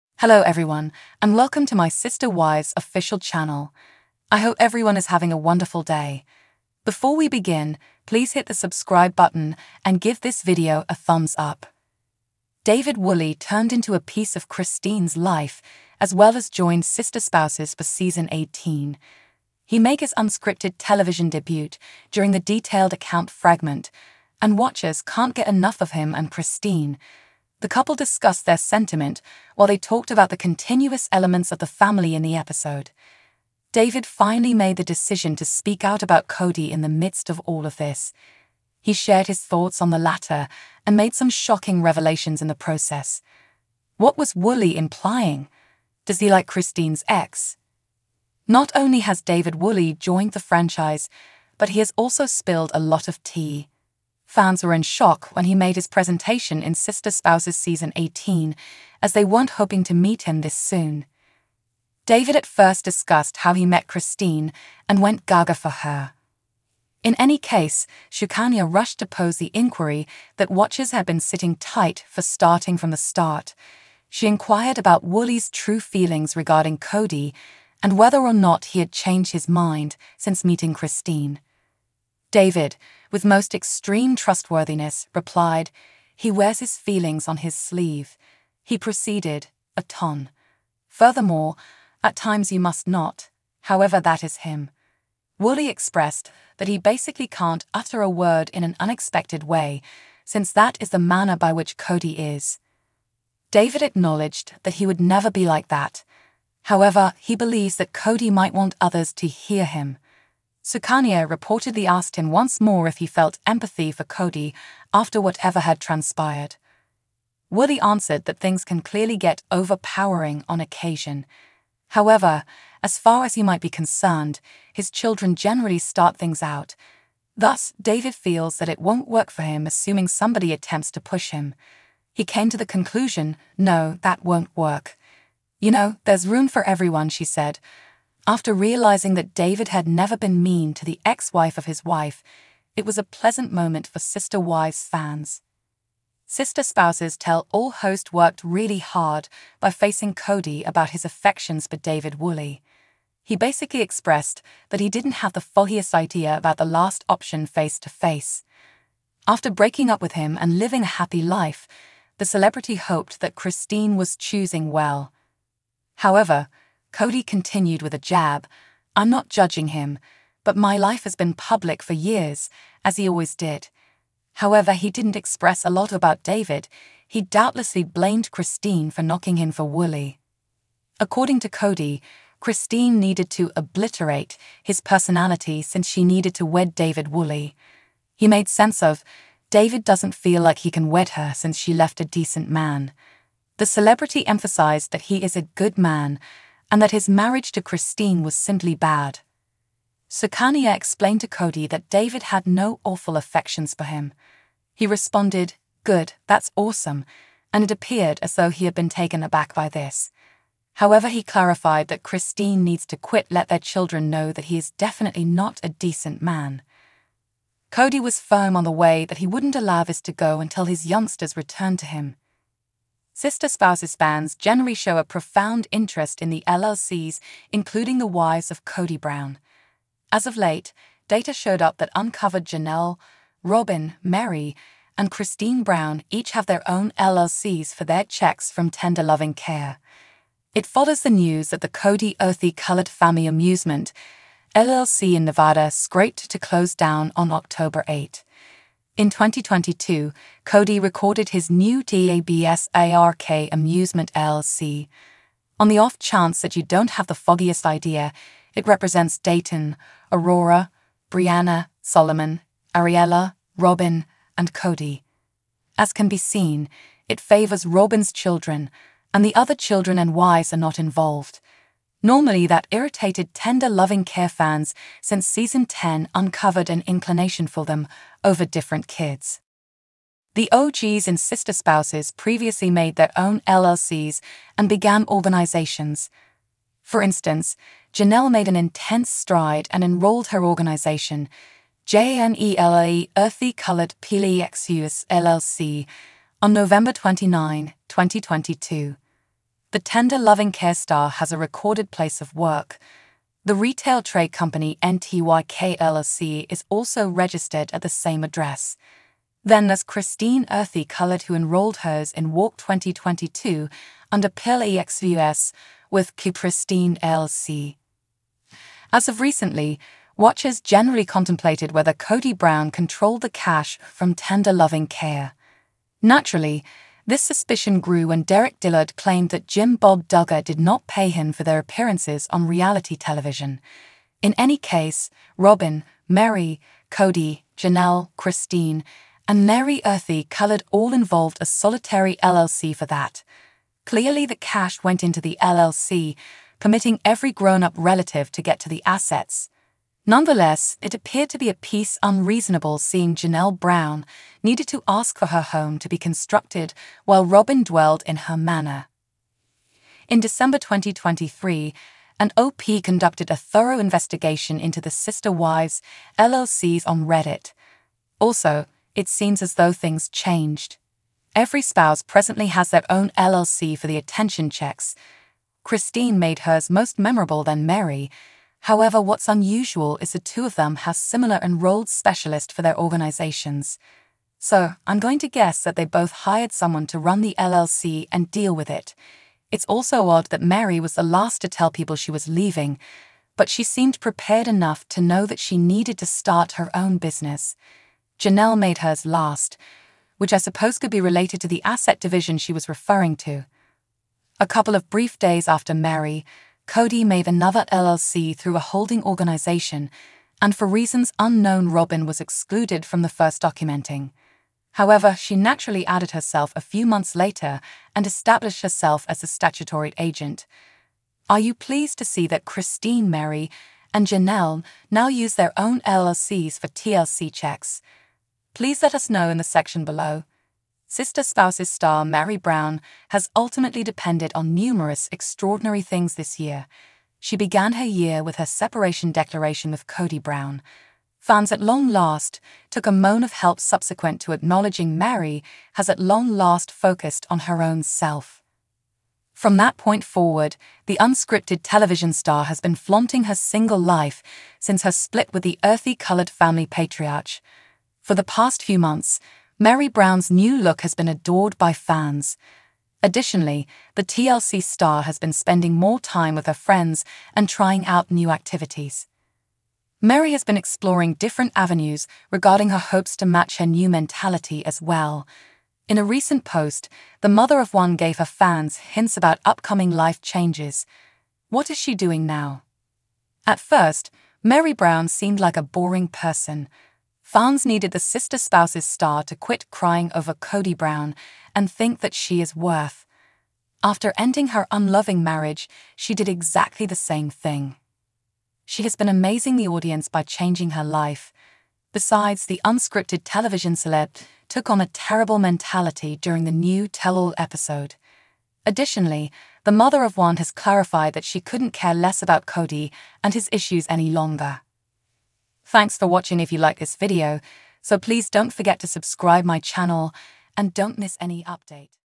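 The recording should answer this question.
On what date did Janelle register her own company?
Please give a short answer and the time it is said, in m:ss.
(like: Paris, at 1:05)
November 29, 2022, at 4:56.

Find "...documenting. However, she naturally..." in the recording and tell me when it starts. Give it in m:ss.
6:53.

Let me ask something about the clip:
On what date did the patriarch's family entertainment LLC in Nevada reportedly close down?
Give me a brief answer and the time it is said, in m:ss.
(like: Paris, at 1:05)
October 8, at 4:07.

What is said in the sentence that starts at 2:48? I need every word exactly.
I'm not judging him, but my life has been public for years, as he always did.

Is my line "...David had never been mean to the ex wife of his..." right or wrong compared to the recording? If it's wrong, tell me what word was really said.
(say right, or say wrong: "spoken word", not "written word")
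right.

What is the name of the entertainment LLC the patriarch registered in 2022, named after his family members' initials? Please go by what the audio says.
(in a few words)
DABS ARK Amusement LLC.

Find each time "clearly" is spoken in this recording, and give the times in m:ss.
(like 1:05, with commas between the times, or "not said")
1:58, 5:43.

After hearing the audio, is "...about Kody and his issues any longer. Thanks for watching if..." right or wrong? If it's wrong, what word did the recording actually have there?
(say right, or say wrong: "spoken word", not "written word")
right.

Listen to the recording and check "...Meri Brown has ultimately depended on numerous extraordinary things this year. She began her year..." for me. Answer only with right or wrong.
right.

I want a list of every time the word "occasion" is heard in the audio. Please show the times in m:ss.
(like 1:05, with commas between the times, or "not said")
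2:00.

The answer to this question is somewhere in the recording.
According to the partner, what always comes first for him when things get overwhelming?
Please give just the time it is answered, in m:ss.
2:04.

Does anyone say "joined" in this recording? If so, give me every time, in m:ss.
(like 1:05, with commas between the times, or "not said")
0:16, 0:49.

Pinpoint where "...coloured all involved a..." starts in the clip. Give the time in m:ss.
5:40.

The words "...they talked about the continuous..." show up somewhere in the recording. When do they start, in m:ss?
0:29.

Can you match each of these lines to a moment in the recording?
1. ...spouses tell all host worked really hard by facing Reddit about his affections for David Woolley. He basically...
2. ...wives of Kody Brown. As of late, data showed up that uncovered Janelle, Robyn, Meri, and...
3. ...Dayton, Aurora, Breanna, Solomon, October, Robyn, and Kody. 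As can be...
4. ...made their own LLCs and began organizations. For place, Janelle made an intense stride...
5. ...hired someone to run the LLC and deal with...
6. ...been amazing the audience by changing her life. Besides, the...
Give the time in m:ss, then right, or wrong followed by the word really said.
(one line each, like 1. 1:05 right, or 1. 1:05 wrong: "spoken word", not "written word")
1. 2:26 wrong: "Kody", not "Reddit"
2. 3:48 right
3. 4:19 wrong: "Ariella", not "October"
4. 4:42 wrong: "instance", not "place"
5. 6:26 right
6. 8:18 right.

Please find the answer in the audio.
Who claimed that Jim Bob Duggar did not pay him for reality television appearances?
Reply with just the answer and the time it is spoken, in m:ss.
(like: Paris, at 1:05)
Derek Dillard, at 5:28.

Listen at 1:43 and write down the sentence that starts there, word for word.
David acknowledged that he would never be like that.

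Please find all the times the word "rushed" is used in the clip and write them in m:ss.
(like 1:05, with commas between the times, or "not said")
1:08.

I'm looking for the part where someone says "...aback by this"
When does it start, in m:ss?
3:29.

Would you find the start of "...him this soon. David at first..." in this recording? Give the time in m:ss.
1:00.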